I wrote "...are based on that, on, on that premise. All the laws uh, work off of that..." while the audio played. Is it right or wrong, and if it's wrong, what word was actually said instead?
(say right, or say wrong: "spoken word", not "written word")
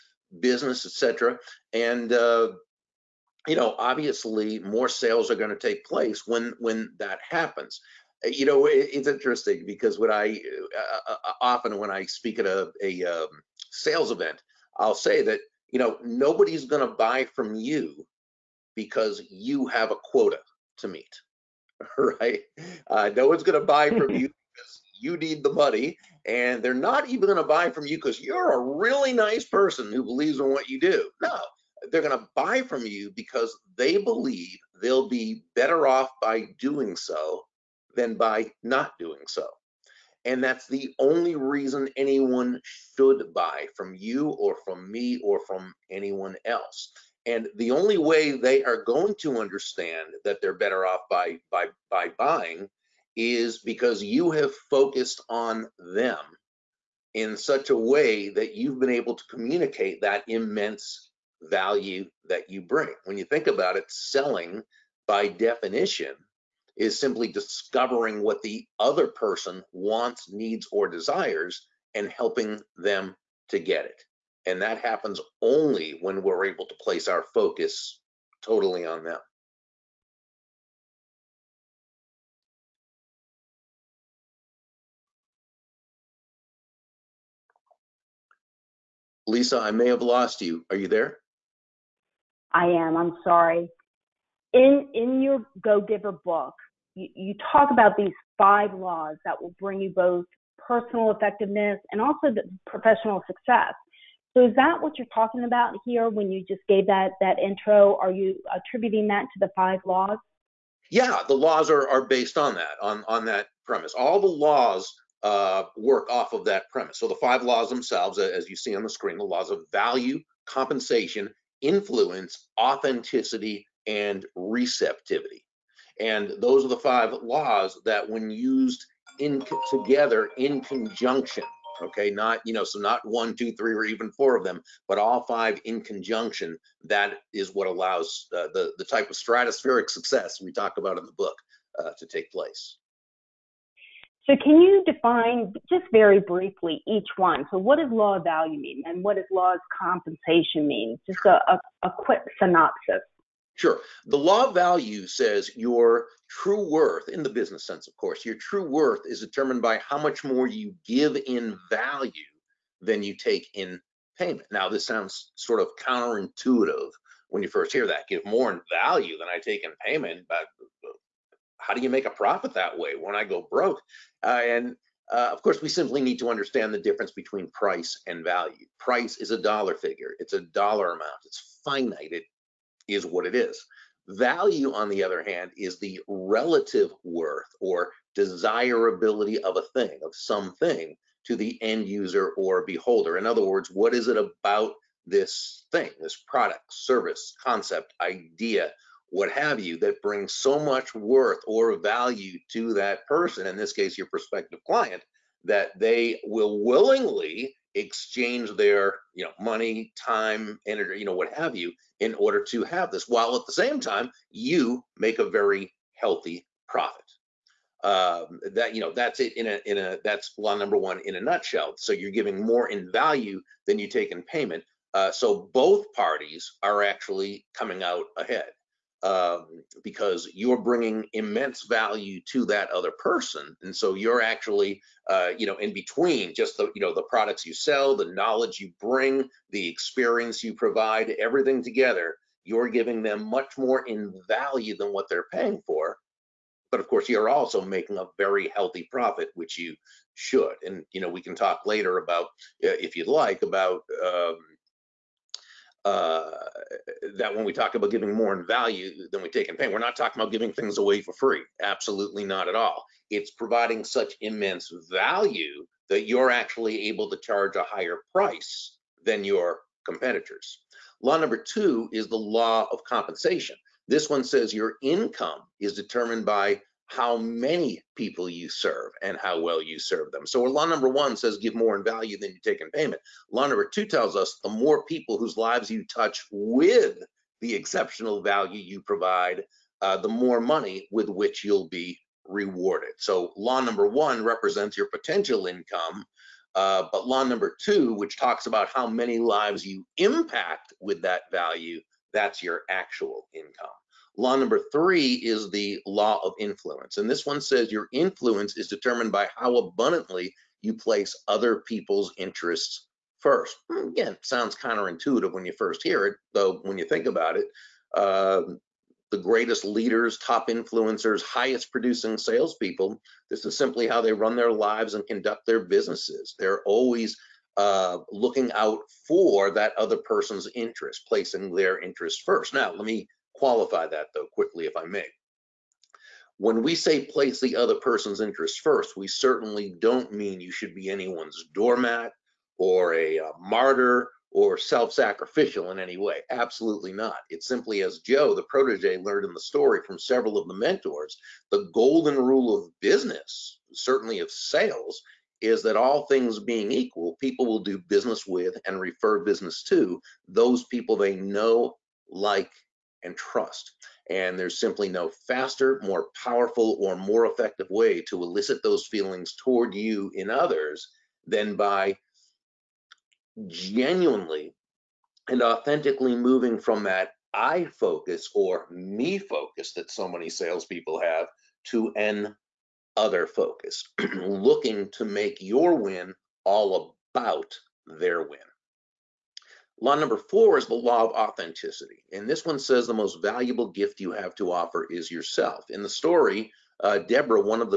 right.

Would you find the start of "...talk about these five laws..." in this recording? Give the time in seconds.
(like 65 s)
97 s.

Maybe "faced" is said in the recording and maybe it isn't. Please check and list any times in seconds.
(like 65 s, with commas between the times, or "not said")
not said.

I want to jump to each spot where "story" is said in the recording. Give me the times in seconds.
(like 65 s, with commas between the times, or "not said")
349 s, 395 s.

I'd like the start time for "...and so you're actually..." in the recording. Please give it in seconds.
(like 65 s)
233 s.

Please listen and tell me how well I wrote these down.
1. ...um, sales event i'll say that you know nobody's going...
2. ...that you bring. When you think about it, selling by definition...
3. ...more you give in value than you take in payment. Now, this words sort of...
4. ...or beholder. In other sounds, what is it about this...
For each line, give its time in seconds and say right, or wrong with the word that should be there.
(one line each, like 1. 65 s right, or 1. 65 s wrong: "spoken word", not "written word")
1. 13 s right
2. 62 s right
3. 160 s wrong: "sounds", not "words"
4. 192 s wrong: "words", not "sounds".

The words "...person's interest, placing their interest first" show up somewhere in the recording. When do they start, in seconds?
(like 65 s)
329 s.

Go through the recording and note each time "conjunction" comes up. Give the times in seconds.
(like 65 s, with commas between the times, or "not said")
130 s, 135 s.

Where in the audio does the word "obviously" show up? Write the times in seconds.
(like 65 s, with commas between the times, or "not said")
3 s.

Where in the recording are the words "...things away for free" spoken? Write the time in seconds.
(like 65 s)
260 s.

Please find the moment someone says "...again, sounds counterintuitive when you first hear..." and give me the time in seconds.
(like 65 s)
313 s.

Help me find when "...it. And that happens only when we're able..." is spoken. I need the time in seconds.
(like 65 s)
73 s.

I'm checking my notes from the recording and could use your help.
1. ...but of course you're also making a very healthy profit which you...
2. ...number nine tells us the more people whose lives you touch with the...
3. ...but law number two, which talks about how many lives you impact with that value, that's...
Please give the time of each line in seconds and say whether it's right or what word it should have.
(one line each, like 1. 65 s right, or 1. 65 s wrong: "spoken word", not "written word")
1. 246 s right
2. 283 s wrong: "two", not "nine"
3. 296 s right.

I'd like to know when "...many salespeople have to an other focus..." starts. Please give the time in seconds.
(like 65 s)
380 s.